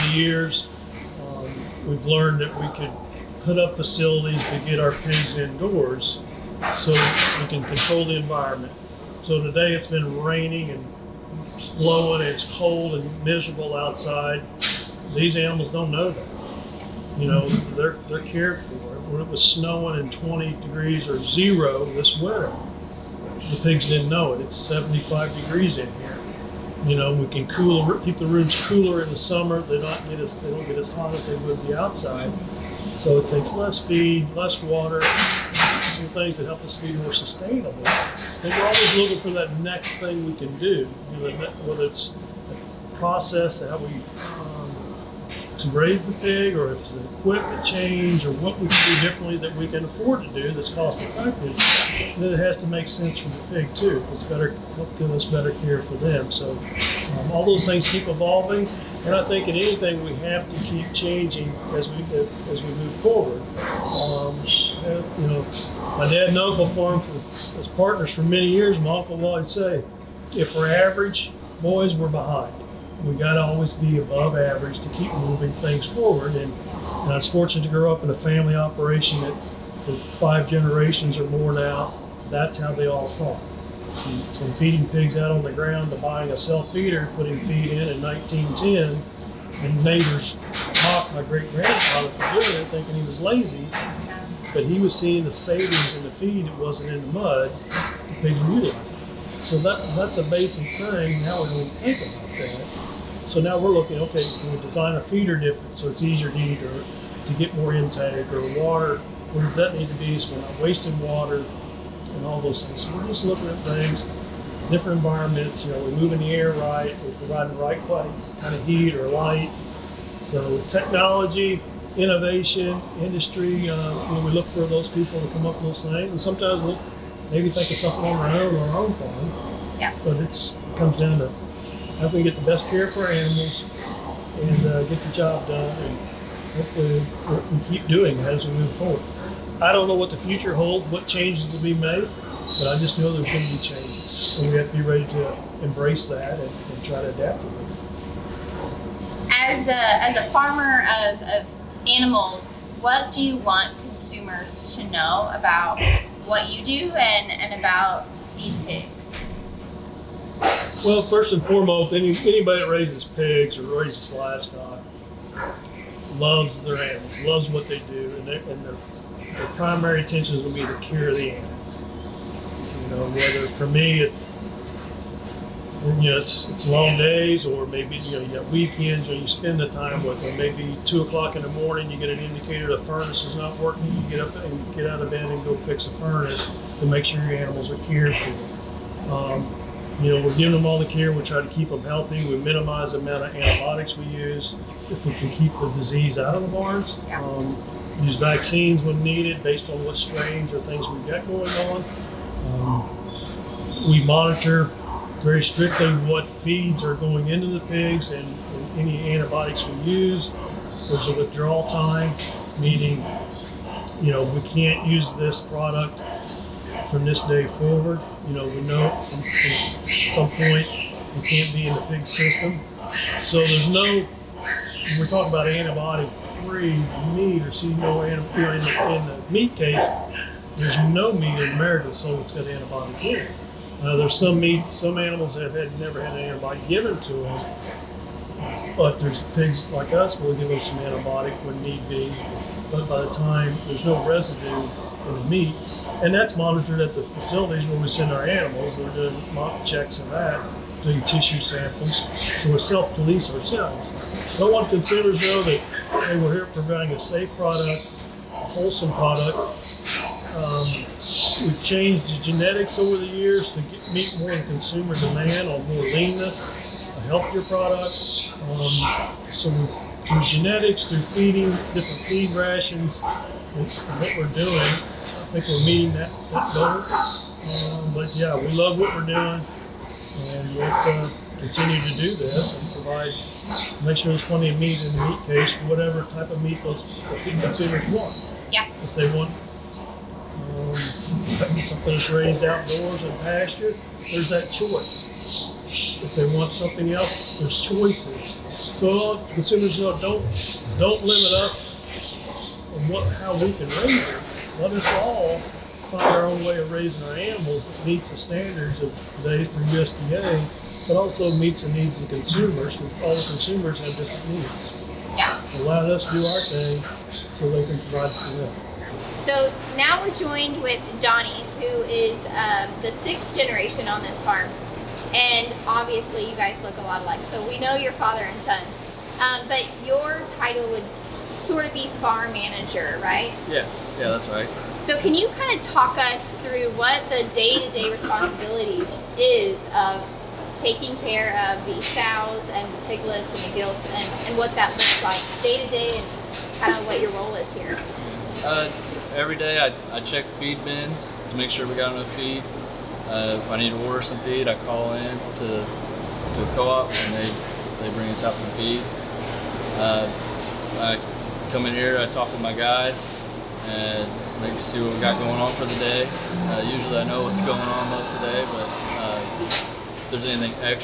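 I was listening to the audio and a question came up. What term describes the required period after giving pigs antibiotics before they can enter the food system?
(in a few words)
withdrawal time.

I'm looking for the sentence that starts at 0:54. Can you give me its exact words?
It's better, give us better care for them.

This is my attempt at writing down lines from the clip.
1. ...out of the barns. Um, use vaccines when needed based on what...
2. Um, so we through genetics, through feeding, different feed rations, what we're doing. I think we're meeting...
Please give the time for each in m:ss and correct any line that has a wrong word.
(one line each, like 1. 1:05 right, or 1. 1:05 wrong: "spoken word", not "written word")
1. 3:16 right
2. 4:28 right.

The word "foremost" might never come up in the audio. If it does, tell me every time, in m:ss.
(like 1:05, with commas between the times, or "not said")
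2:41.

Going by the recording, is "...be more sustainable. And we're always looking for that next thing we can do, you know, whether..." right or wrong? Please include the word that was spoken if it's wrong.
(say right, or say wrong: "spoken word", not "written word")
right.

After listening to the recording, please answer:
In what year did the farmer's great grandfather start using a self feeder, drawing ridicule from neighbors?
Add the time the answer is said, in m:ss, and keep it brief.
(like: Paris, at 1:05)
1910, at 1:28.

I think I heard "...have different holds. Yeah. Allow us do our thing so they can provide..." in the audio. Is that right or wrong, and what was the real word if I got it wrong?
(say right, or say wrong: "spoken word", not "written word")
wrong: "needs", not "holds".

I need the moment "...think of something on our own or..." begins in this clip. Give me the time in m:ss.
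2:07.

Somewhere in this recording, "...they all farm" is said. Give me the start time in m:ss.
1:22.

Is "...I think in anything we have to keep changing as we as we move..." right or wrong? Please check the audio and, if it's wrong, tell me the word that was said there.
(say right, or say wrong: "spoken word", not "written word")
right.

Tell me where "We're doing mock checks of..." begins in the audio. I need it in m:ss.
4:08.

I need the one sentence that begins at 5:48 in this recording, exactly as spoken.
Uh, every day I, I check feed bins to make sure we got enough feed.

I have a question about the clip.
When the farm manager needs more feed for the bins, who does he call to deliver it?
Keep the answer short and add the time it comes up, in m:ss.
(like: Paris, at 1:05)
co-op, at 5:56.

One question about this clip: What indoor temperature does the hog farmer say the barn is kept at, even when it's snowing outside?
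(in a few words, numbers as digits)
75 degrees.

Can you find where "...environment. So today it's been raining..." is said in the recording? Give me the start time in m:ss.
0:08.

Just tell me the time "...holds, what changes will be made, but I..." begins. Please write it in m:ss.
2:20.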